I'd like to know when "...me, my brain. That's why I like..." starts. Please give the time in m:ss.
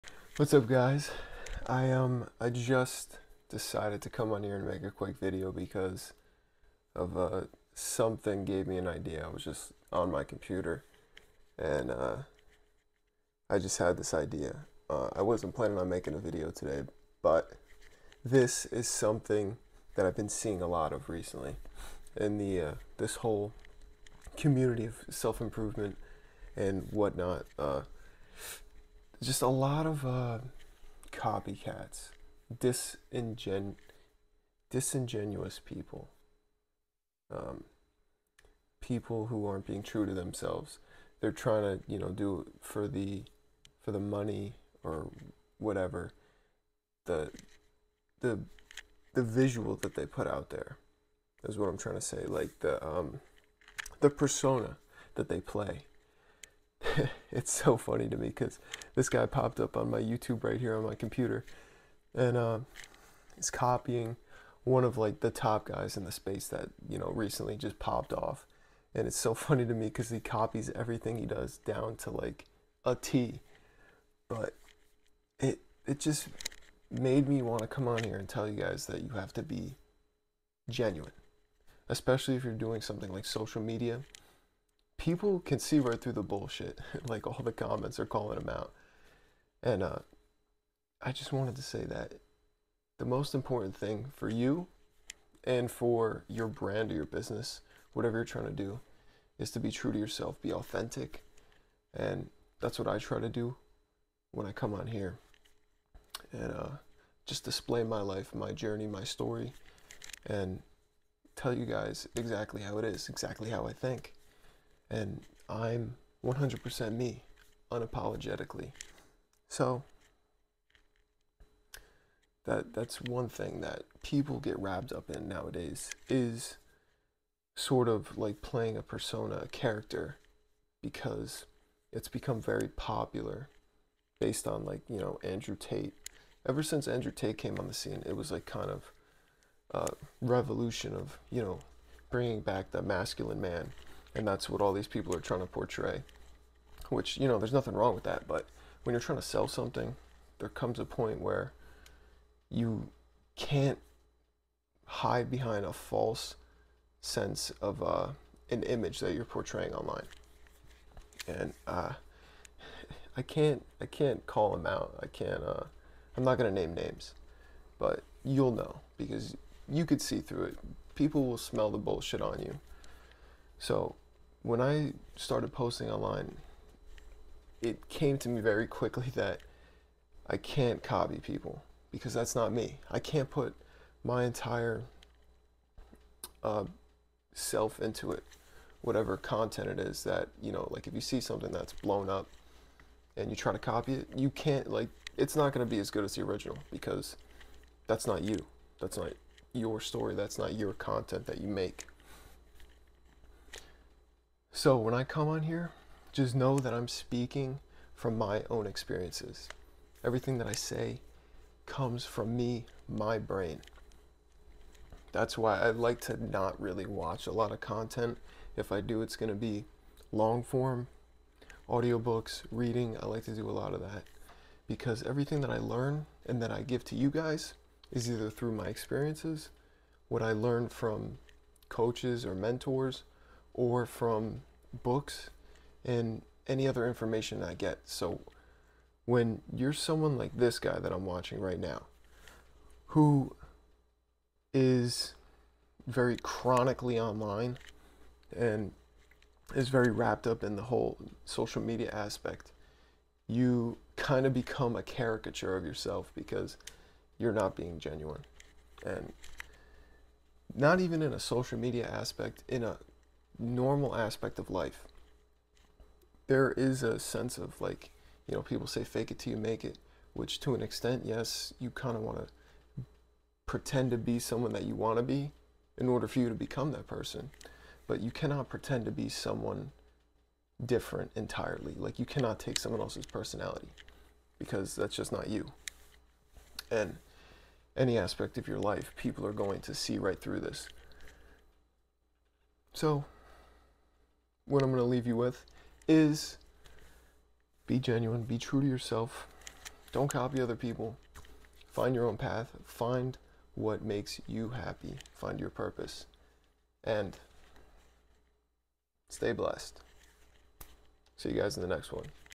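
3:32.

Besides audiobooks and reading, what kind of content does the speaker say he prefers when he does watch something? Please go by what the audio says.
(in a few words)
long form.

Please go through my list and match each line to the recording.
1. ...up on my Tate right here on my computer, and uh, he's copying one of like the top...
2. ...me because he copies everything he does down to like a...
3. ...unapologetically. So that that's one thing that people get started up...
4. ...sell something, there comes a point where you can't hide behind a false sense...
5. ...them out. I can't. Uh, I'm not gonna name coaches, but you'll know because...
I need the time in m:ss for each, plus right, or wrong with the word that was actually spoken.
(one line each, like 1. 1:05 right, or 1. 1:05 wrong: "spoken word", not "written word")
1. 0:59 wrong: "YouTube", not "Tate"
2. 1:09 right
3. 1:57 wrong: "wrapped", not "started"
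4. 2:29 right
5. 2:44 wrong: "names", not "coaches".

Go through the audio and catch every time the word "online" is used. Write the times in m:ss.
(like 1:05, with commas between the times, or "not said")
2:39, 2:55, 4:06.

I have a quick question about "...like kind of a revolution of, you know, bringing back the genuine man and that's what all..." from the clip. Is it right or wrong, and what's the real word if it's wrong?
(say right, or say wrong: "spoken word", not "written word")
wrong: "masculine", not "genuine".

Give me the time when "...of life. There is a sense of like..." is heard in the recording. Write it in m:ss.
4:24.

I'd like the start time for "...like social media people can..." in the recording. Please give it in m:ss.
1:23.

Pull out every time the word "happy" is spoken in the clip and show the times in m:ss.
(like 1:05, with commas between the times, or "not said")
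5:04.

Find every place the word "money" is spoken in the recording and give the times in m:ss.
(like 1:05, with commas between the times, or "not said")
0:43.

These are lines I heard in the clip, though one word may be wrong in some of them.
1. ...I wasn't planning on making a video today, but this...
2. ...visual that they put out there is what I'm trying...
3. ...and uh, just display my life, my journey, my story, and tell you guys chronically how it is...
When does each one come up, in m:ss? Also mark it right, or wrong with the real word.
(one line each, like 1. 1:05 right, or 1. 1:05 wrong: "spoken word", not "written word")
1. 0:15 right
2. 0:49 right
3. 1:46 wrong: "exactly", not "chronically".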